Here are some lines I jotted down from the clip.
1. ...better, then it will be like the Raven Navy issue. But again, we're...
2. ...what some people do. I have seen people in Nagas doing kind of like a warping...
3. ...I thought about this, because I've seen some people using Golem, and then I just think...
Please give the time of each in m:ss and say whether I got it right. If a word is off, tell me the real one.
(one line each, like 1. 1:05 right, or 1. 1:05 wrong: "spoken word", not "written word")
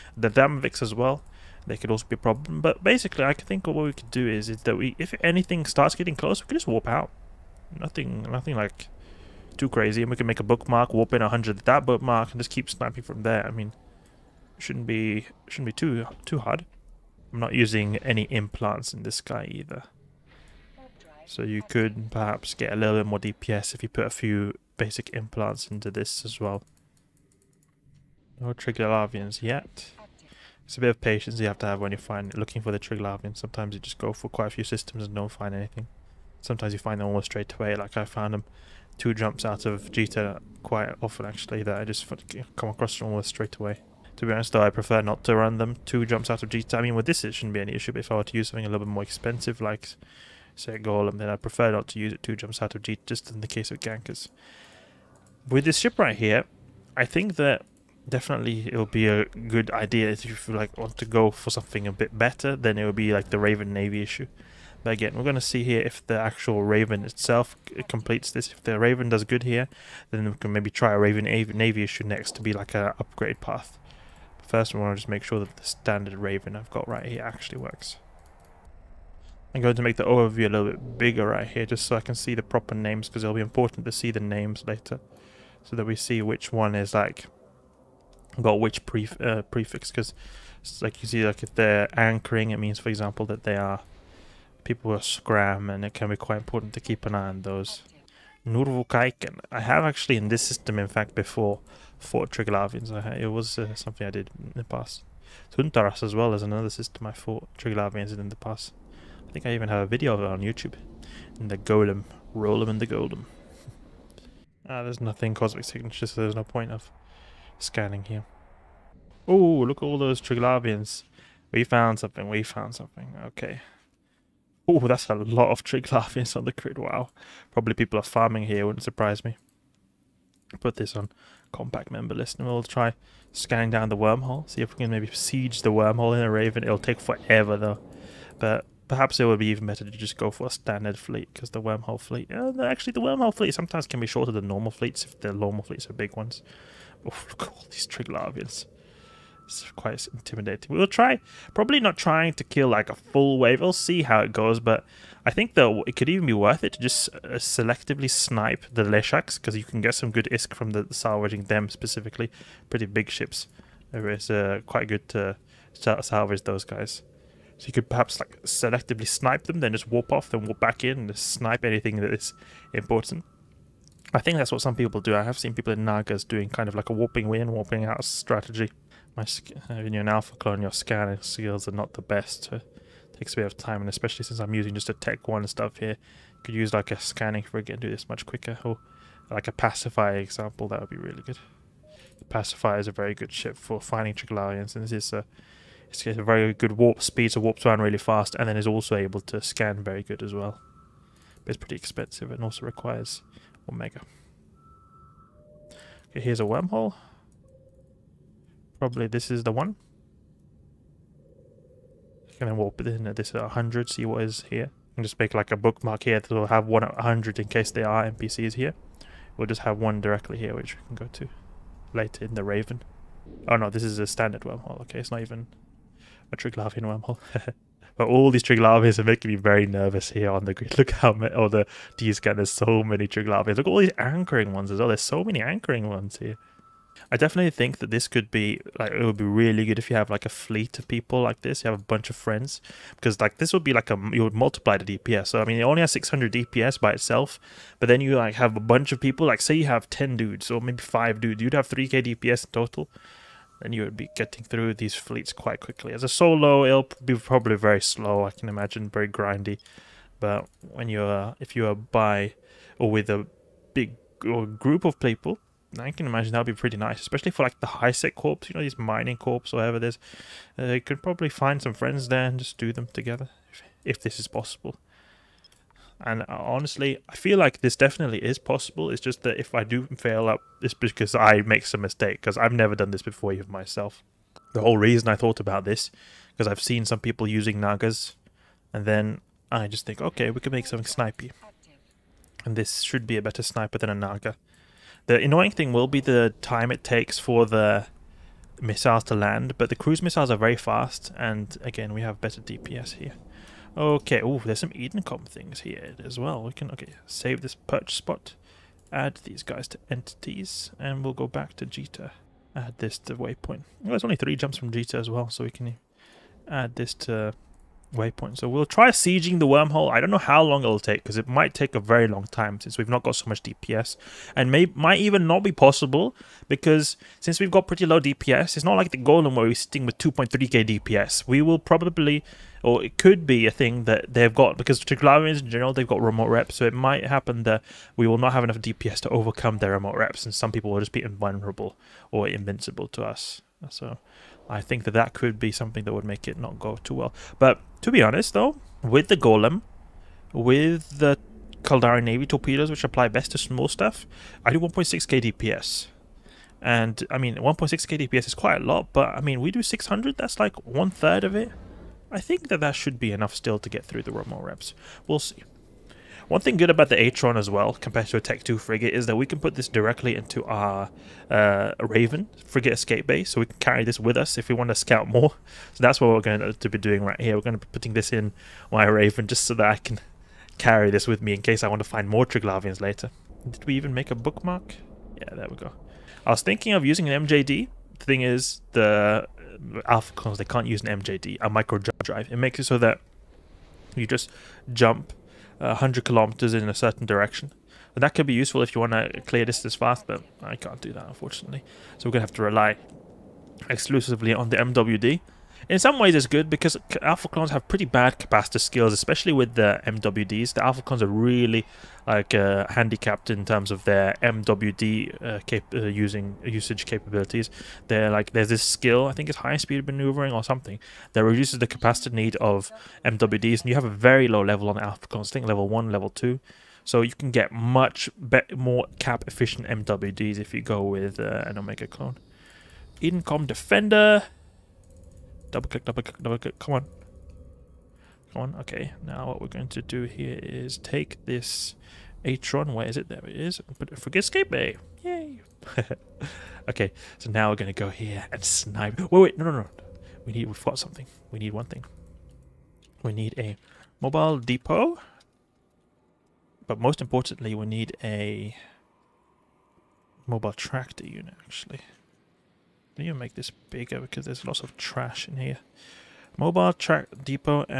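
1. 1:02 right
2. 2:54 right
3. 4:45 wrong: "Nagas", not "Golem".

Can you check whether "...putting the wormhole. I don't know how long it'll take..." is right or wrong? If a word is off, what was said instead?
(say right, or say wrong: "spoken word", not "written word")
wrong: "sieging", not "putting".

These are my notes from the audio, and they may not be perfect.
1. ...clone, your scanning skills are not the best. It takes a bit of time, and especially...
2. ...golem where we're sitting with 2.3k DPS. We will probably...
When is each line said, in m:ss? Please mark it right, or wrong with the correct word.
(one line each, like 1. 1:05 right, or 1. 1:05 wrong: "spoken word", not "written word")
1. 3:00 right
2. 5:28 right.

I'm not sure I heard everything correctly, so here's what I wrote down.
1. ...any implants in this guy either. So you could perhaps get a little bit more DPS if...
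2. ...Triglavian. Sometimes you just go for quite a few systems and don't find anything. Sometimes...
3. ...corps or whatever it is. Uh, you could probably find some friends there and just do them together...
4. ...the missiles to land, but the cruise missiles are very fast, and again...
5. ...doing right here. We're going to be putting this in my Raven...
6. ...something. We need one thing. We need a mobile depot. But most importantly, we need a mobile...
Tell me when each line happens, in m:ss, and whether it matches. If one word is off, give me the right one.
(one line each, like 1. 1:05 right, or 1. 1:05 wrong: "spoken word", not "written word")
1. 0:17 right
2. 0:32 right
3. 4:29 right
4. 4:57 right
5. 6:16 right
6. 7:30 right.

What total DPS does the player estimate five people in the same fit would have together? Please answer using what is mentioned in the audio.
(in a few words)
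3k.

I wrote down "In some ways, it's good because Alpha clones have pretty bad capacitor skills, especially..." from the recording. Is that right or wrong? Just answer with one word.
right.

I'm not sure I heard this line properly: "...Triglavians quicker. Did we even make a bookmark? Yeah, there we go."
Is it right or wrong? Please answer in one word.
wrong.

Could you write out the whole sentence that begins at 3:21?
But it's pretty expensive and also requires Omega.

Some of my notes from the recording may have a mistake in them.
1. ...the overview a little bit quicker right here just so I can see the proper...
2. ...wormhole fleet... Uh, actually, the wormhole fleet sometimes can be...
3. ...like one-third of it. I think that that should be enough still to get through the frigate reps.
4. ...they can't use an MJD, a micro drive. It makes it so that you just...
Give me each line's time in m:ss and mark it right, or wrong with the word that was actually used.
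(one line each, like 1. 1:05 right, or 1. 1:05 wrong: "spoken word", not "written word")
1. 1:19 wrong: "bigger", not "quicker"
2. 2:21 right
3. 6:00 wrong: "remote", not "frigate"
4. 6:30 right.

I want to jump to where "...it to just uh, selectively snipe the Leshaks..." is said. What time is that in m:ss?
2:36.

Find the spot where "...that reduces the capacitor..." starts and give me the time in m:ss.
7:01.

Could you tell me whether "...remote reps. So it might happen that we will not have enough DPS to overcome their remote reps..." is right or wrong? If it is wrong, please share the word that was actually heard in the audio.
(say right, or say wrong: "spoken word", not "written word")
right.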